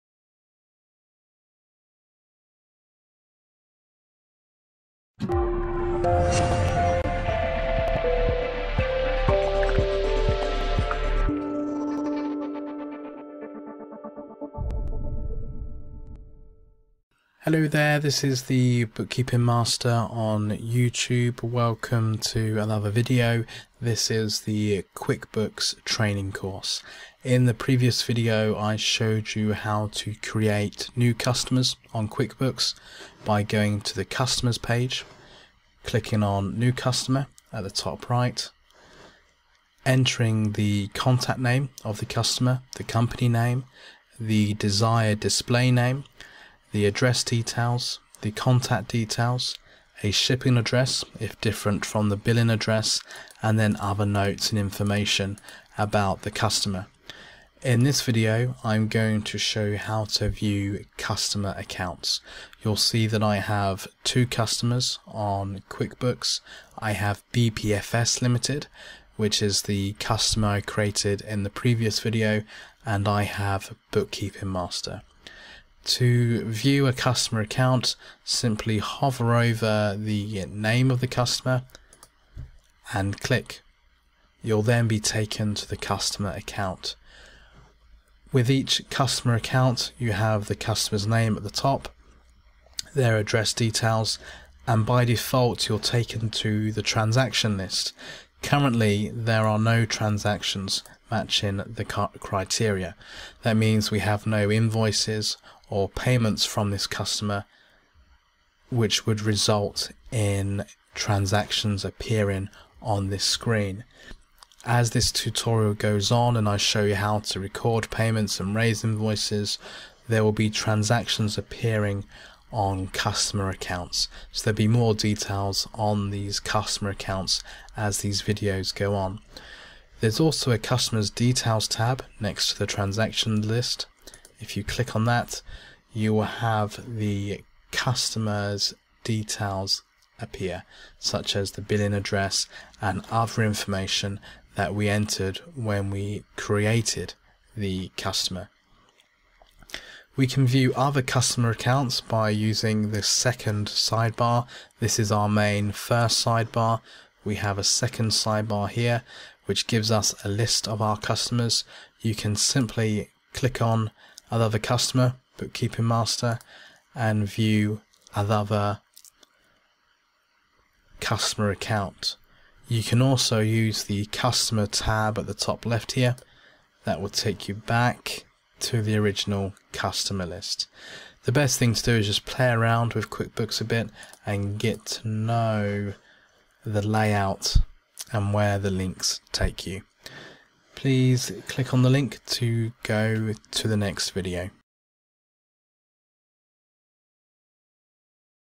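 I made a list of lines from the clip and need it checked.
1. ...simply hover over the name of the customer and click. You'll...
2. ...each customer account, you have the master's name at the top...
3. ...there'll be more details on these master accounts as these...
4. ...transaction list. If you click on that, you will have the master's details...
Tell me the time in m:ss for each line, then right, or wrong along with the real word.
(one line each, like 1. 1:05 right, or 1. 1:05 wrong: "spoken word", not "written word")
1. 1:18 right
2. 1:28 wrong: "customer", not "master"
3. 2:04 wrong: "customer", not "master"
4. 2:12 wrong: "customer", not "master".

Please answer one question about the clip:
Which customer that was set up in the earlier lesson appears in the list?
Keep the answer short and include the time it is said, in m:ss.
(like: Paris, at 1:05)
BPFS Limited, at 1:07.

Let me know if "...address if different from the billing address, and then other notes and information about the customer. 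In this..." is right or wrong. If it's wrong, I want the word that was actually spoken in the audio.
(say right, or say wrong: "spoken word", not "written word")
right.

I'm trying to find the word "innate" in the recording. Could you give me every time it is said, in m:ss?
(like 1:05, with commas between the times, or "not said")
not said.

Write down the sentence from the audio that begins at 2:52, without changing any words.
You can also use the customer tab at the top left here.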